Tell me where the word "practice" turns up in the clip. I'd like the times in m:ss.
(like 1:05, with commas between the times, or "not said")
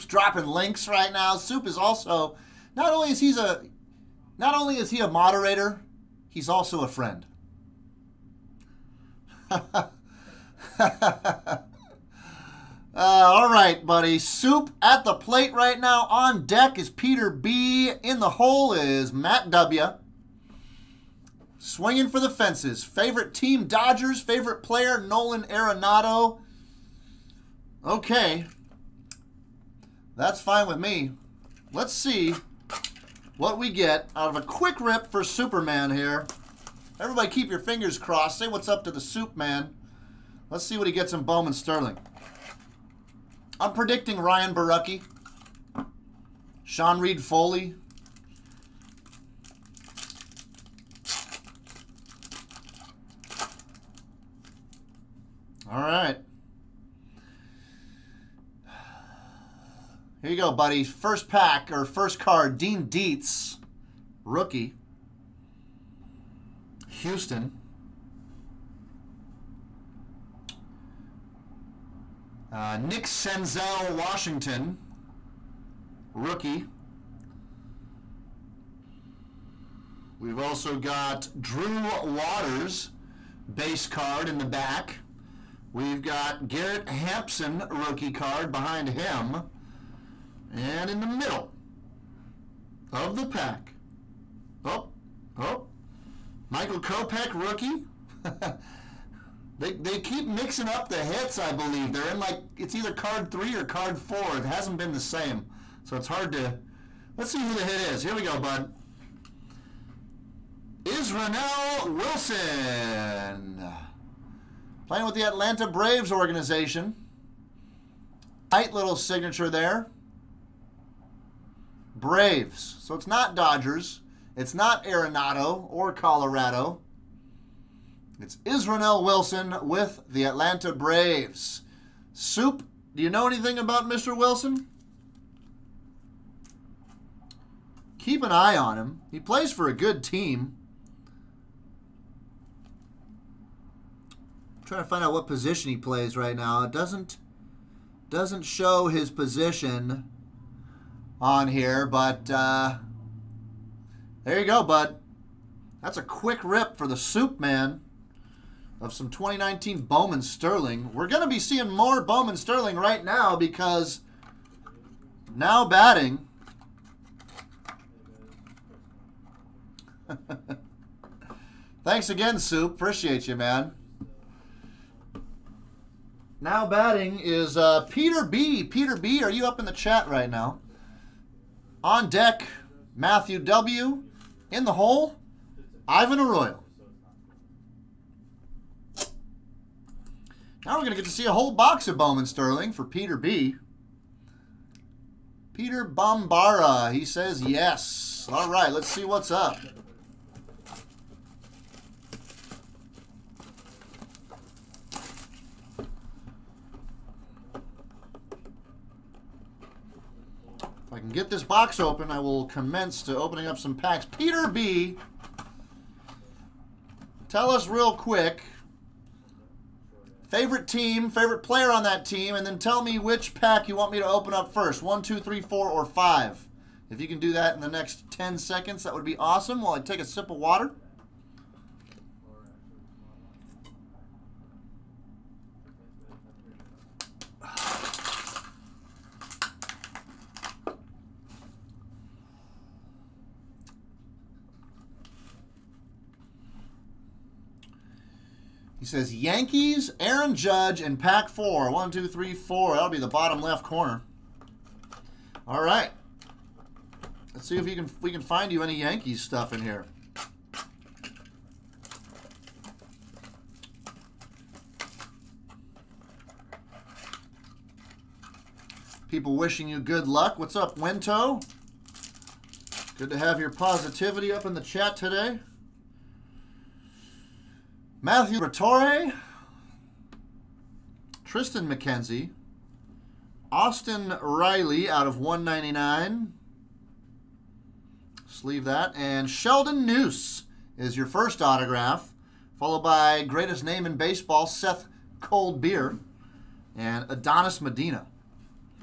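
not said.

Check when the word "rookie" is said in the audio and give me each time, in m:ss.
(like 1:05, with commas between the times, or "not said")
1:04, 1:16, 1:27, 1:37.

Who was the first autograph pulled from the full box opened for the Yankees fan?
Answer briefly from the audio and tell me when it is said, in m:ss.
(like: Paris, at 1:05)
Sheldon Neuse, at 4:49.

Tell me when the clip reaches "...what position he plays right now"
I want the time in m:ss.
2:25.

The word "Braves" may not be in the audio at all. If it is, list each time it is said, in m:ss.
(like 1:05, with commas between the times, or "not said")
1:55, 2:01, 2:10.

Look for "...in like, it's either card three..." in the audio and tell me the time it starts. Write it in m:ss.
1:42.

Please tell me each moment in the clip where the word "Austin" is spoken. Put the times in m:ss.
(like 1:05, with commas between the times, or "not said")
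4:43.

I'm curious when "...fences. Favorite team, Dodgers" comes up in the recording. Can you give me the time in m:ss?
0:22.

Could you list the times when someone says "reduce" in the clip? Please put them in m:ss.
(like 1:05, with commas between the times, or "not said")
not said.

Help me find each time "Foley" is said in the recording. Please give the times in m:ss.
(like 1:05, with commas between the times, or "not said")
0:47.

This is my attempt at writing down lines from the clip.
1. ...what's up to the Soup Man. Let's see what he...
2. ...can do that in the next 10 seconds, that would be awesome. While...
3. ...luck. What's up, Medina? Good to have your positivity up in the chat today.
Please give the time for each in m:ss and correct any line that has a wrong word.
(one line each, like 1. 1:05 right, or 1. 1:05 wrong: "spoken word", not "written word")
1. 0:38 right
2. 3:47 right
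3. 4:30 wrong: "Winto", not "Medina".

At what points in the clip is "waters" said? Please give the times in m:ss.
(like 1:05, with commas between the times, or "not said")
1:22, 3:50.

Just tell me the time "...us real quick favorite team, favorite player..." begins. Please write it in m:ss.
3:37.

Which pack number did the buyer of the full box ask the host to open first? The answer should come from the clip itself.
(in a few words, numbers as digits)
4.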